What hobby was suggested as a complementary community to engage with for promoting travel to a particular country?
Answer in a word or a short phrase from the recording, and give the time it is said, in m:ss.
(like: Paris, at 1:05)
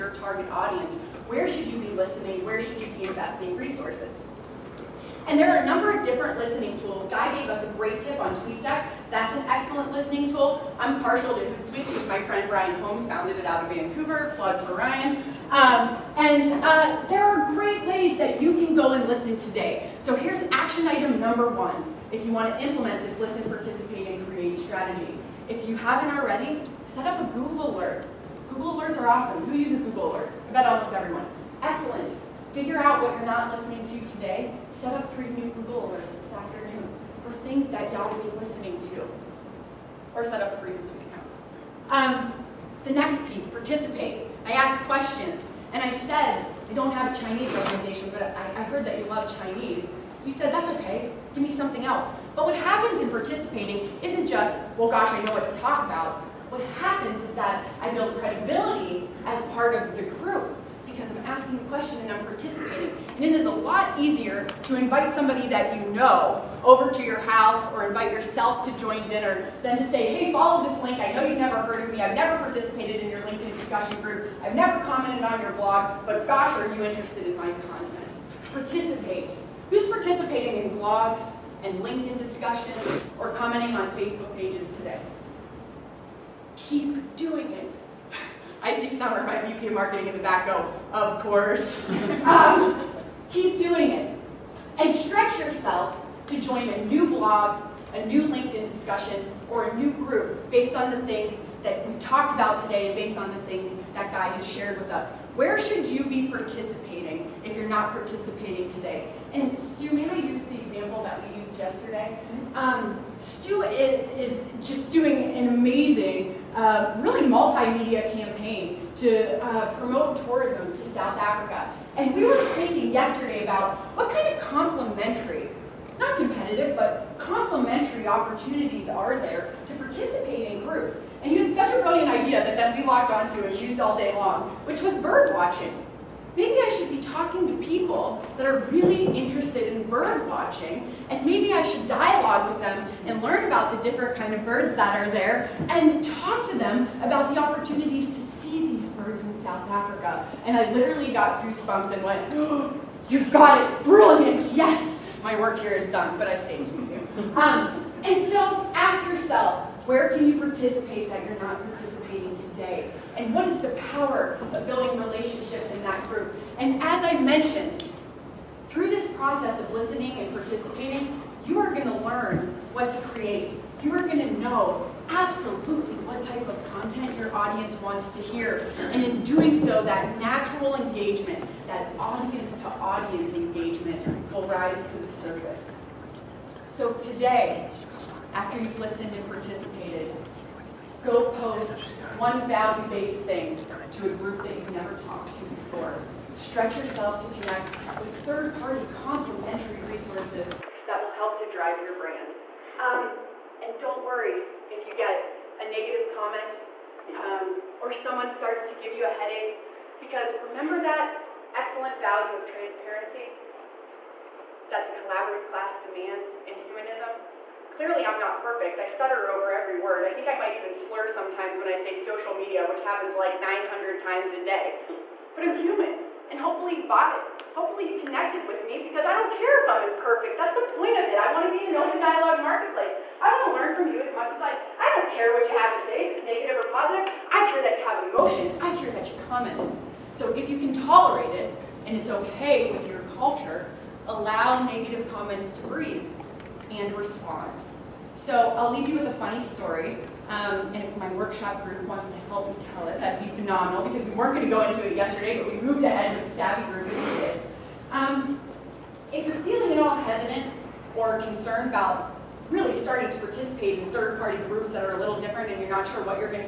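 Bird watching, at 2:14.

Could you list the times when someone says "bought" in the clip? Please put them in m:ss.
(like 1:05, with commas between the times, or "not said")
3:46.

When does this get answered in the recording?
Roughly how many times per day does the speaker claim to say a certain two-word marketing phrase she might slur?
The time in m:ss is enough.
3:43.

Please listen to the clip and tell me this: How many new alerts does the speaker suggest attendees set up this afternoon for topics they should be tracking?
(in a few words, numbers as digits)
3.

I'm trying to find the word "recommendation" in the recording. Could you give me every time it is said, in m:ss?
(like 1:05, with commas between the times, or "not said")
0:47.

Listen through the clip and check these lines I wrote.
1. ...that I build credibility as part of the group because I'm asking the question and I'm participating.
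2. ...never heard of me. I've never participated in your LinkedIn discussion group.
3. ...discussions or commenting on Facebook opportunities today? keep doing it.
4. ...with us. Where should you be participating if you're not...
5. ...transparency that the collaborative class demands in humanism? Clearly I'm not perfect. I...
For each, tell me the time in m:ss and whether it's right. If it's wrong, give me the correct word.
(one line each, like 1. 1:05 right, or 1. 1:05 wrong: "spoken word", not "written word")
1. 0:57 right
2. 1:11 right
3. 1:22 wrong: "pages", not "opportunities"
4. 1:44 right
5. 3:32 right.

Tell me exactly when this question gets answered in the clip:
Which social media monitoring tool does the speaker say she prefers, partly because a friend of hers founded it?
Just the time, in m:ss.
0:11.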